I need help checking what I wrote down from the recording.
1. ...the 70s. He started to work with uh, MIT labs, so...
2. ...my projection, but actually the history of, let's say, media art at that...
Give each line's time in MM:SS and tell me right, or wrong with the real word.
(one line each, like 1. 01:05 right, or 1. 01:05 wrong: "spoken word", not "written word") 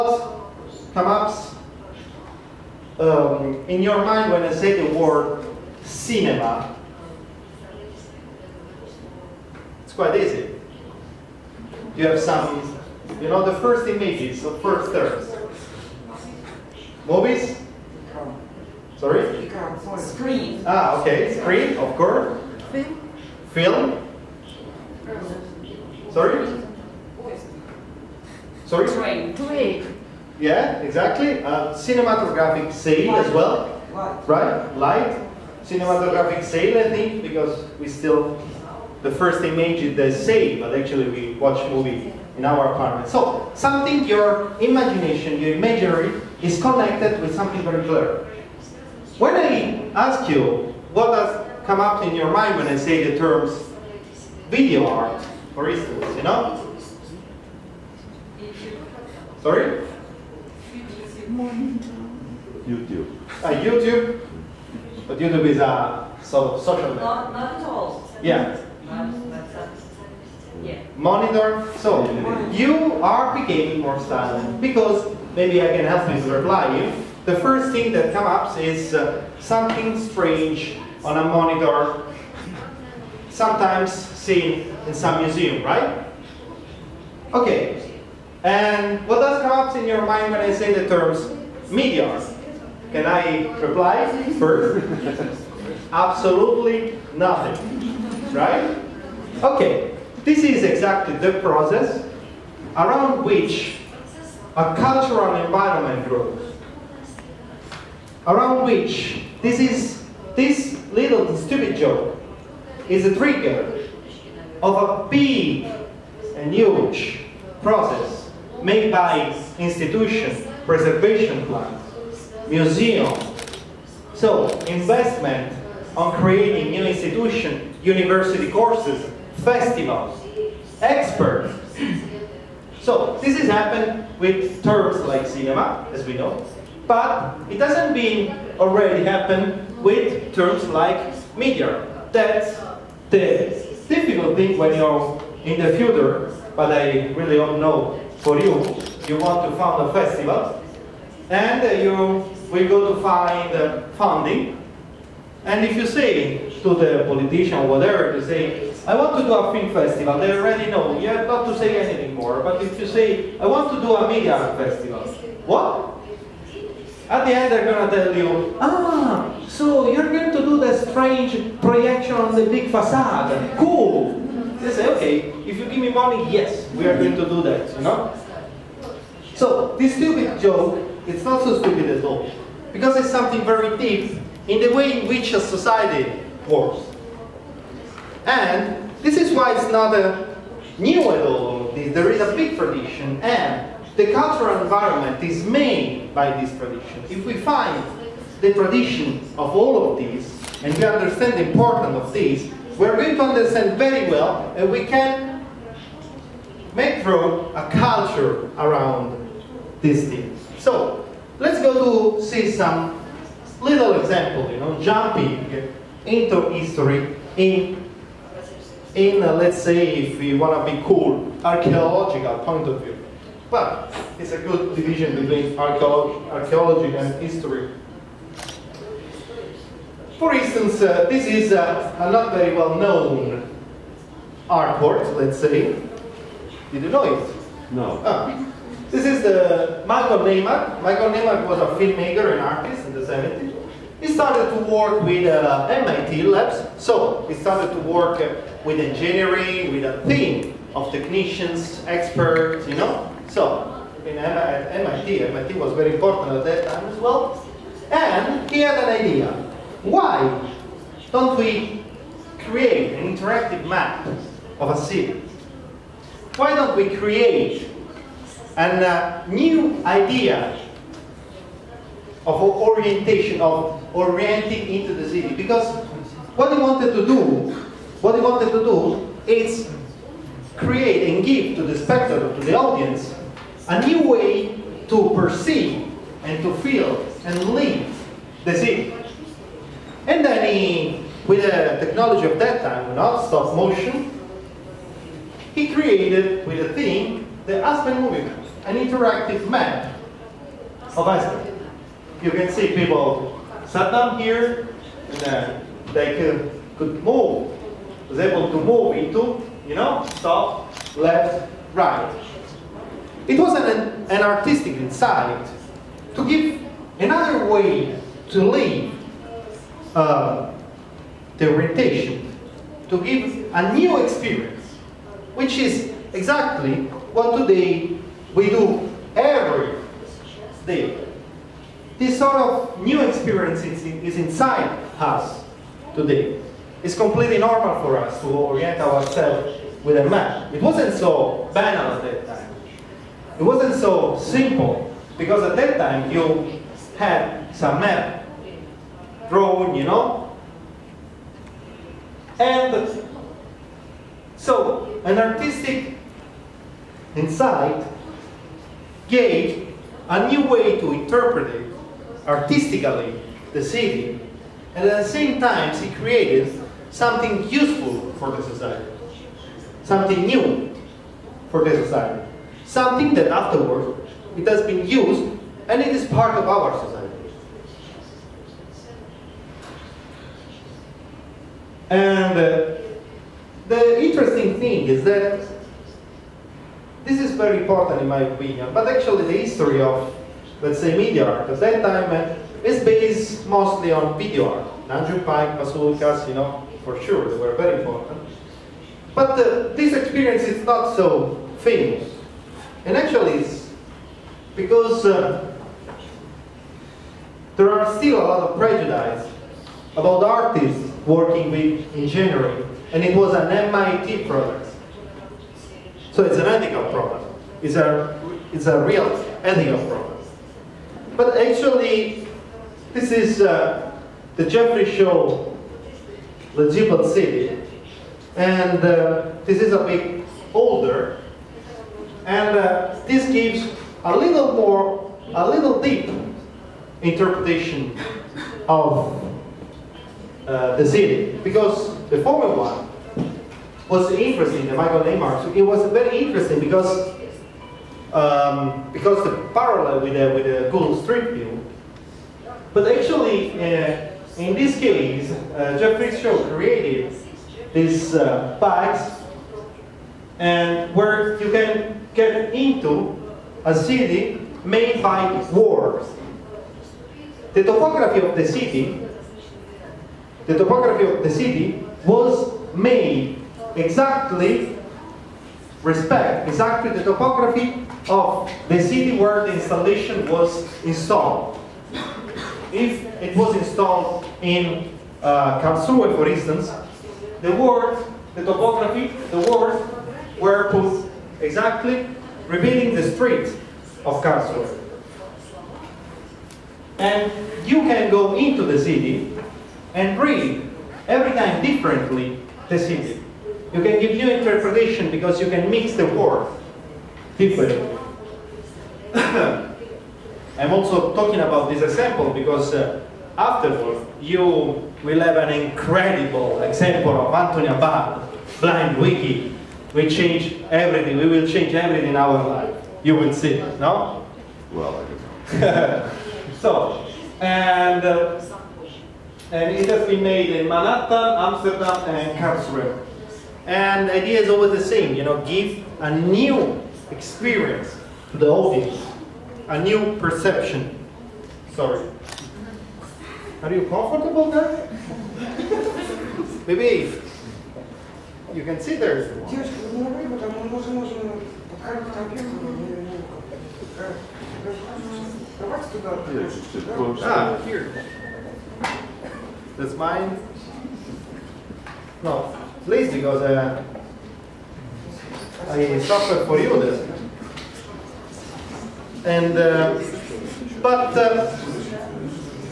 1. 04:02 right
2. 06:28 wrong: "opinion", not "projection".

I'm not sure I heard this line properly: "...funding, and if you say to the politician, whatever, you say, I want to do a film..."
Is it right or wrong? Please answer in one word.
right.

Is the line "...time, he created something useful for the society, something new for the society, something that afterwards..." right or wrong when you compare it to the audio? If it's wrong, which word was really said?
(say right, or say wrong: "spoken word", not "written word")
right.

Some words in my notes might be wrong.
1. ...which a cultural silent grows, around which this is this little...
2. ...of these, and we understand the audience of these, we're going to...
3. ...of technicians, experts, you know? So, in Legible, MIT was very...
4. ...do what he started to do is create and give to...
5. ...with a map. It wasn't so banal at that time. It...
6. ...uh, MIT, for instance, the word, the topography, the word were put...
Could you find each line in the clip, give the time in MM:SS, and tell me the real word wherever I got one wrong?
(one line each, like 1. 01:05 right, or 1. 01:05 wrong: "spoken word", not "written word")
1. 01:43 wrong: "environment", not "silent"
2. 03:19 wrong: "importance", not "audience"
3. 04:10 wrong: "MIT", not "Legible"
4. 04:37 wrong: "wanted", not "started"
5. 05:39 right
6. 08:05 wrong: "Karlsruhe", not "MIT".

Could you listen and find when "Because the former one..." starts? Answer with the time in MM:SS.
07:21.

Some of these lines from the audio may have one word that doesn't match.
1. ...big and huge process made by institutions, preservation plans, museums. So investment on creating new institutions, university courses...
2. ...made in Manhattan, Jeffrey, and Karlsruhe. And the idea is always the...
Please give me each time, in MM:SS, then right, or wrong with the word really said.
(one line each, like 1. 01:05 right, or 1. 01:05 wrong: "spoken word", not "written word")
1. 01:55 right
2. 08:50 wrong: "Amsterdam", not "Jeffrey".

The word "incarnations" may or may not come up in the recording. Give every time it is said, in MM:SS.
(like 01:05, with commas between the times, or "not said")
not said.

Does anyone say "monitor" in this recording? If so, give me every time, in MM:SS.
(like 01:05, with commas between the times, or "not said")
01:10, 01:21.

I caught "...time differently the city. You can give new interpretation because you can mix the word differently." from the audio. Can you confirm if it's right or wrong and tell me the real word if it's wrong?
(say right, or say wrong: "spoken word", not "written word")
right.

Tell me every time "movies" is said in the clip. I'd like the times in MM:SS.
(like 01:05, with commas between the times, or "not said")
00:17, 00:41.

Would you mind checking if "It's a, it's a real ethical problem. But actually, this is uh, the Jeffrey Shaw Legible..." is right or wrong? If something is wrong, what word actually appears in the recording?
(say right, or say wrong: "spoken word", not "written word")
right.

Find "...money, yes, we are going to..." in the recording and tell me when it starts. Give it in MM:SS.
02:55.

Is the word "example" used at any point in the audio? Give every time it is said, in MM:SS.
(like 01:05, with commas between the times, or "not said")
03:33, 08:31, 08:36.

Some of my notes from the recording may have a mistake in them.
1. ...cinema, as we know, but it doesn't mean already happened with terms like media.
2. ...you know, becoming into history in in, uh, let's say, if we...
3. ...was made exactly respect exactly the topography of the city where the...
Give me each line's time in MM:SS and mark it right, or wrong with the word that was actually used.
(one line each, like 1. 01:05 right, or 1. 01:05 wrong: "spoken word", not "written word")
1. 02:15 right
2. 03:34 wrong: "jumping", not "becoming"
3. 07:52 right.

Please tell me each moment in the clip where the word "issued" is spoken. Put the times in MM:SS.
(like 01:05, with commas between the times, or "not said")
not said.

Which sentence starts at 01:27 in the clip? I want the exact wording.
Okay, and what does come up in your mind when I say the terms meteor?